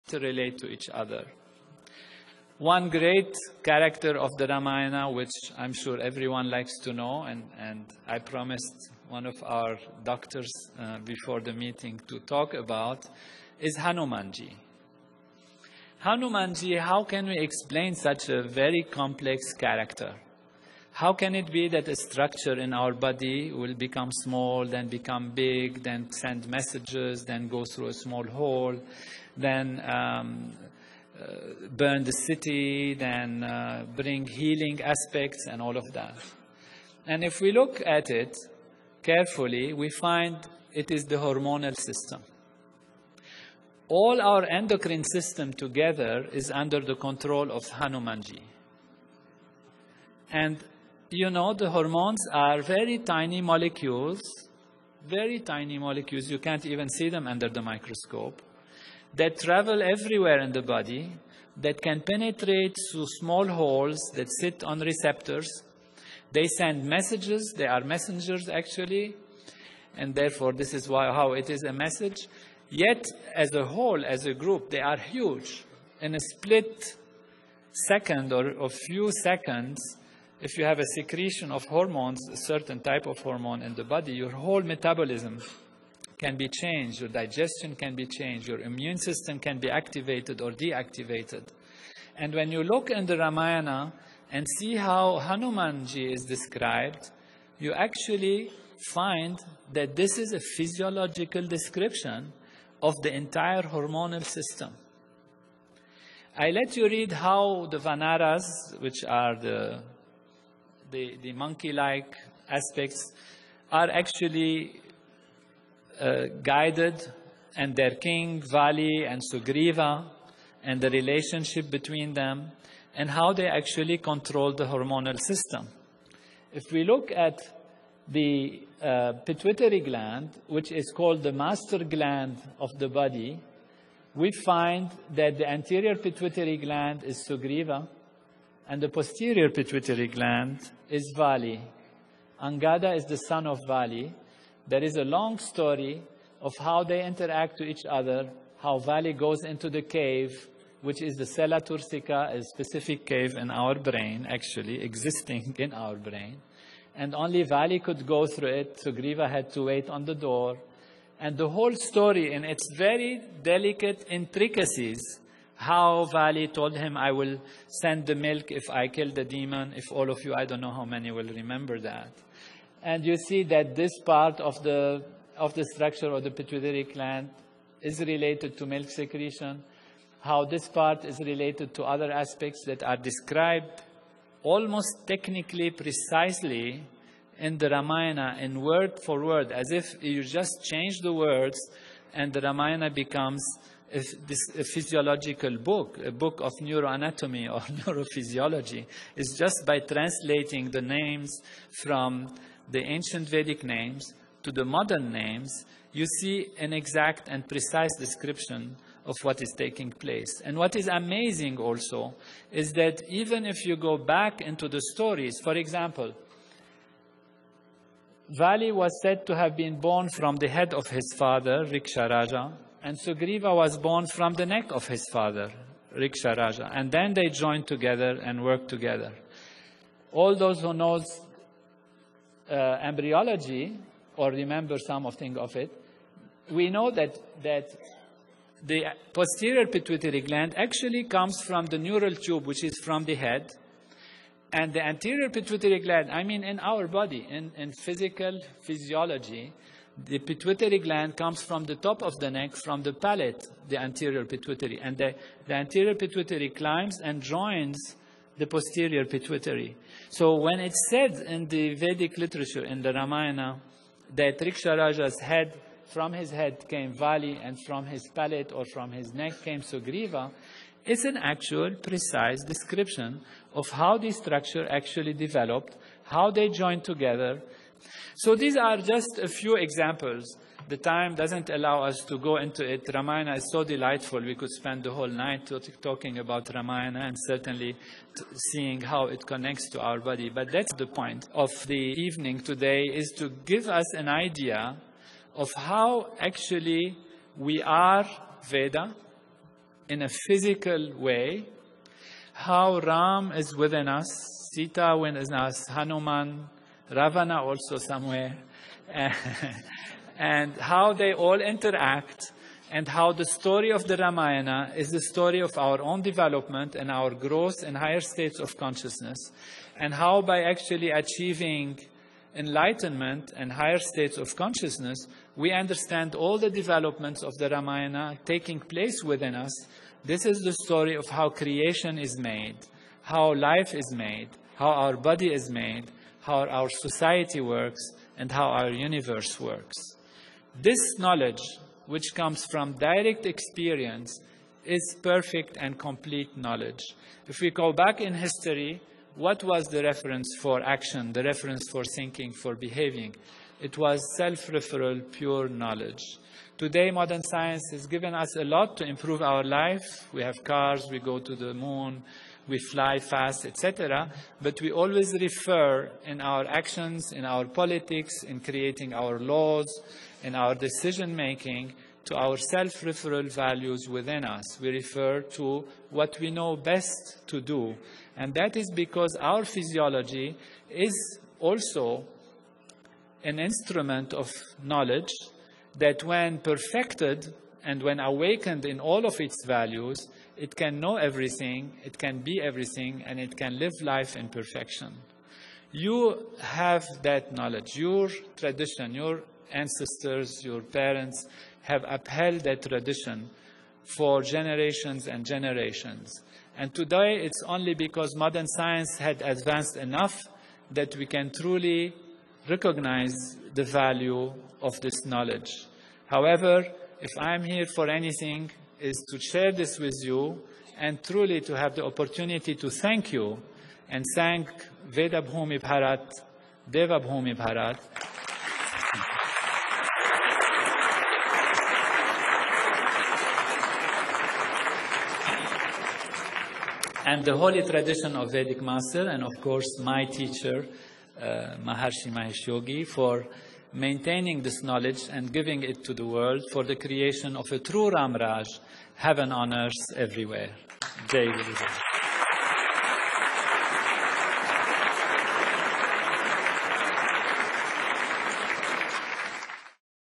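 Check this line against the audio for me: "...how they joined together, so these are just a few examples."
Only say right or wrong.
right.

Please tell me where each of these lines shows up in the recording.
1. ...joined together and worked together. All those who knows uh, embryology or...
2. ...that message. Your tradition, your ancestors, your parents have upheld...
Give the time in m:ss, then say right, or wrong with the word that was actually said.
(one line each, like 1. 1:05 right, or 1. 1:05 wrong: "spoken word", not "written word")
1. 3:47 right
2. 6:37 wrong: "knowledge", not "message".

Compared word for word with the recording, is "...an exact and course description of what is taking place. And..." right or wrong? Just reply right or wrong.
wrong.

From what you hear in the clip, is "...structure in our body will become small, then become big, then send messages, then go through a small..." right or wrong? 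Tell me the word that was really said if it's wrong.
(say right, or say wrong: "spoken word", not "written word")
right.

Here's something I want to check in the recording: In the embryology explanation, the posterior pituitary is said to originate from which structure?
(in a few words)
The neural tube.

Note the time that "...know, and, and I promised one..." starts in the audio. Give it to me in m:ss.
0:06.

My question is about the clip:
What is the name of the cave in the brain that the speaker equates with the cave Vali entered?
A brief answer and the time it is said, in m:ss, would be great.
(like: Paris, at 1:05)
Sella turcica, at 2:31.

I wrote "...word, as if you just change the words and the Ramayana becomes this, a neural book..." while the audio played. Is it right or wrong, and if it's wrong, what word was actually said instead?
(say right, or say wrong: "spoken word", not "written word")
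wrong: "physiological", not "neural".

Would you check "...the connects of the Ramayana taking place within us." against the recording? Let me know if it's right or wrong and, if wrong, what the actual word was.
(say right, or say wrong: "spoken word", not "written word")
wrong: "developments", not "connects".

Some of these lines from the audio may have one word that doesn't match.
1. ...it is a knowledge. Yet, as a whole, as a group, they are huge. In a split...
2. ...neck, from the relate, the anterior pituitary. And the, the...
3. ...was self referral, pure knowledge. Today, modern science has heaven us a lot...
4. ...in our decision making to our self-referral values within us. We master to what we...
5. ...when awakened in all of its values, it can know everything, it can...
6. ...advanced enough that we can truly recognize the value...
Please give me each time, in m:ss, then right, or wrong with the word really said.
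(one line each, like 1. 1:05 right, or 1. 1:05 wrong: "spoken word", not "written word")
1. 1:11 wrong: "message", not "knowledge"
2. 4:12 wrong: "palate", not "relate"
3. 5:53 wrong: "given", not "heaven"
4. 6:10 wrong: "refer", not "master"
5. 6:27 right
6. 6:49 right.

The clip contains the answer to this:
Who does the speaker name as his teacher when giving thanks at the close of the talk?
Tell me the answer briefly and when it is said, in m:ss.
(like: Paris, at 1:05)
Maharishi Mahesh Yogi, at 7:21.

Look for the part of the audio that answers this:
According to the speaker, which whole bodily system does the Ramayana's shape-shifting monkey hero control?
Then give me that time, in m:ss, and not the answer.
0:44.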